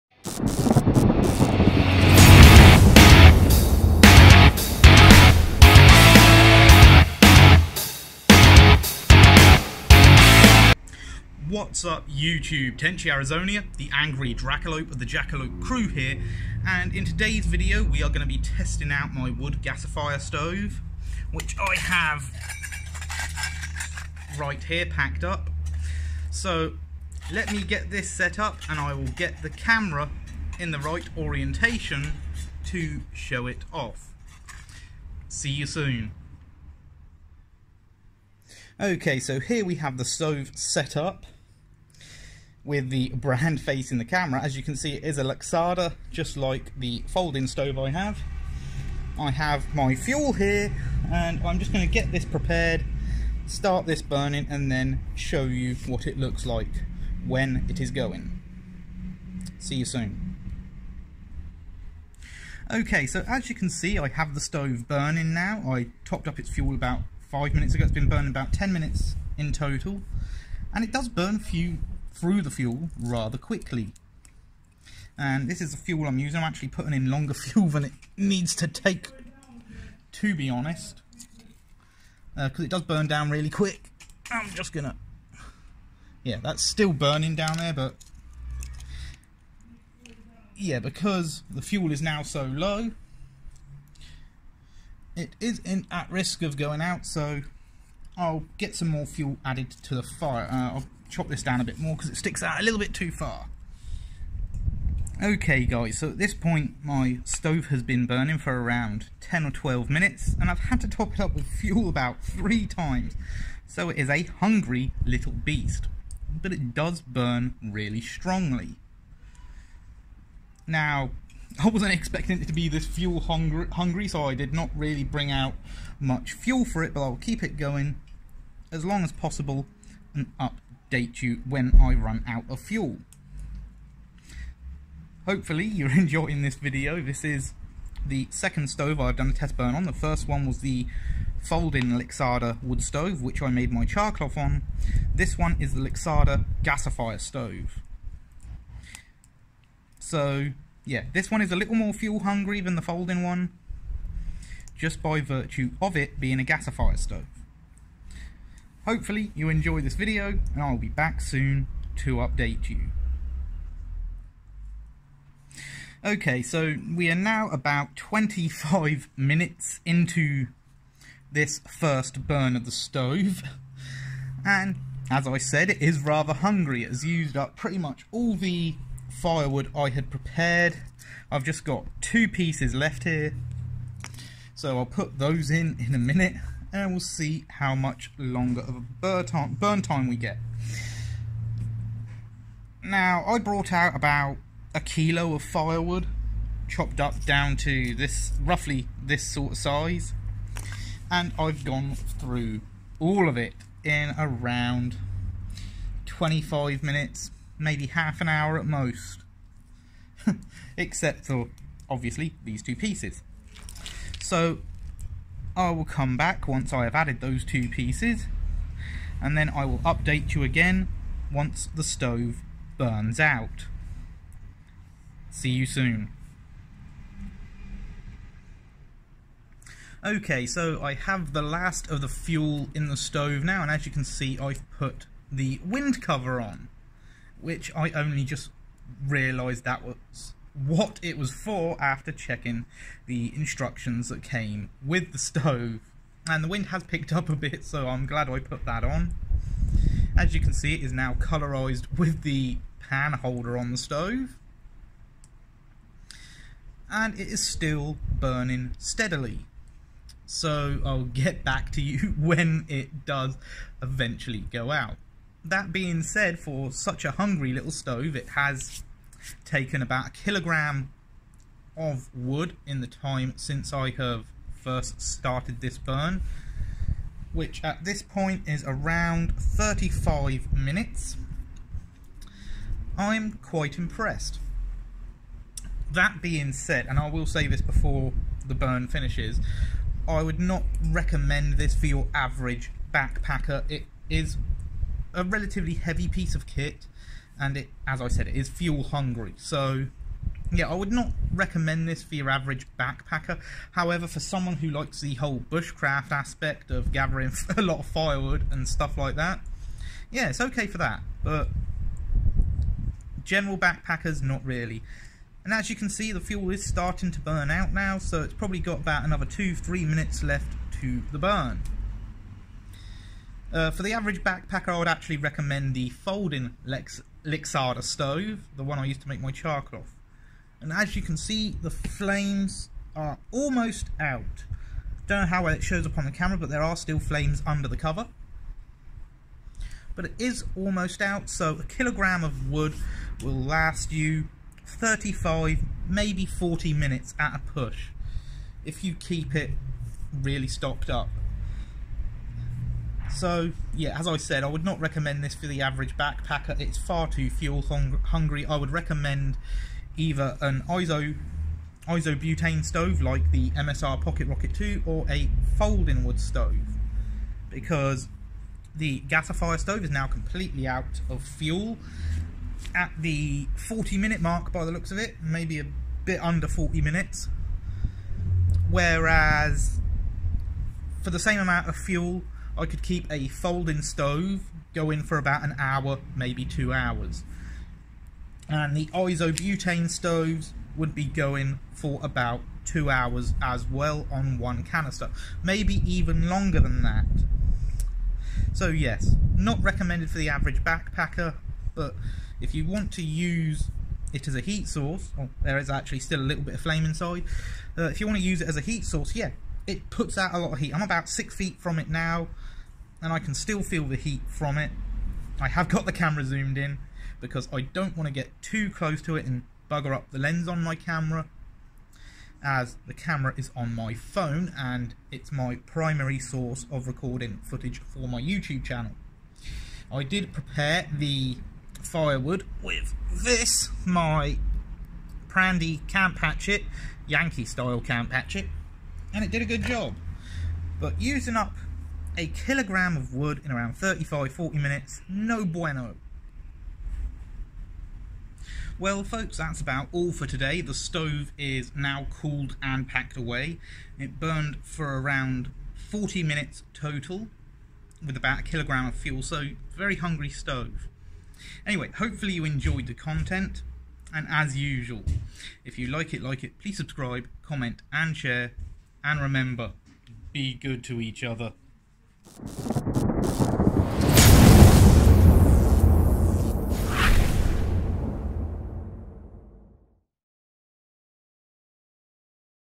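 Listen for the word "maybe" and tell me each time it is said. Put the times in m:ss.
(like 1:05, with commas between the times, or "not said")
3:27, 5:45, 6:15, 6:26, 6:35.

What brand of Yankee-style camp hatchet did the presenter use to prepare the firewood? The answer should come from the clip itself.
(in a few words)
Prandy.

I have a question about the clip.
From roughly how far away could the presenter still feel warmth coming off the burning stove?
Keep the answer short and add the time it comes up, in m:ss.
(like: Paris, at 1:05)
6 feet, at 6:51.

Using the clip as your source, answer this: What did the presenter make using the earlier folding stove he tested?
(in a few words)
charcloth.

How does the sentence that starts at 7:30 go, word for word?
The stove is now cooled and packed away.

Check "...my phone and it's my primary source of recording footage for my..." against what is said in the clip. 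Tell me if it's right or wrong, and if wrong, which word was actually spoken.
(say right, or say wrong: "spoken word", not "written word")
right.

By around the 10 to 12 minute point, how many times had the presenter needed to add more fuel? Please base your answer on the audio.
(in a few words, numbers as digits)
3.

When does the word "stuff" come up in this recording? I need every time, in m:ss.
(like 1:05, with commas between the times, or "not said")
5:08.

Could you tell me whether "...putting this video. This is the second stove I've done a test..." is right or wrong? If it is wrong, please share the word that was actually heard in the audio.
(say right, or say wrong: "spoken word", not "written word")
wrong: "enjoying", not "putting".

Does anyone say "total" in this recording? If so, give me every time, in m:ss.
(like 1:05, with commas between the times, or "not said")
1:09, 7:36.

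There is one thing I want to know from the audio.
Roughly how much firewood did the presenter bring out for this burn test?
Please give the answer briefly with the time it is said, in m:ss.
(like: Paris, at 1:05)
1 kilo, at 3:13.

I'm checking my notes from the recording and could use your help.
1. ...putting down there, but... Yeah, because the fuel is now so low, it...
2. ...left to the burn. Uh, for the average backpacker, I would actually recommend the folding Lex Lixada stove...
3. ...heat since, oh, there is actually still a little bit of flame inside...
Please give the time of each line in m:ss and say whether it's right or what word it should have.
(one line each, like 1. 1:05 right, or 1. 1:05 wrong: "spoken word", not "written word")
1. 1:26 wrong: "burning", not "putting"
2. 5:20 right
3. 6:44 wrong: "source", not "since".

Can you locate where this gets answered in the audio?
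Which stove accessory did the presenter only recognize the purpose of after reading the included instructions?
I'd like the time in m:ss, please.
3:55.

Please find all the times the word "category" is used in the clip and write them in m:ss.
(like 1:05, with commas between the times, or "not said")
not said.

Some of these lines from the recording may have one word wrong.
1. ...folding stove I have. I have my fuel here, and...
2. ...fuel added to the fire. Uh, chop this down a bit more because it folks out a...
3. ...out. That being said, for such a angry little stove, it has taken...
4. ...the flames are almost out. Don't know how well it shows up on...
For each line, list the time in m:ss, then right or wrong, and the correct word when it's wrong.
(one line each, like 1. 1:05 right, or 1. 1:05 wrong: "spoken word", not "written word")
1. 0:47 right
2. 1:39 wrong: "sticks", not "folks"
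3. 4:24 wrong: "hungry", not "angry"
4. 5:31 right.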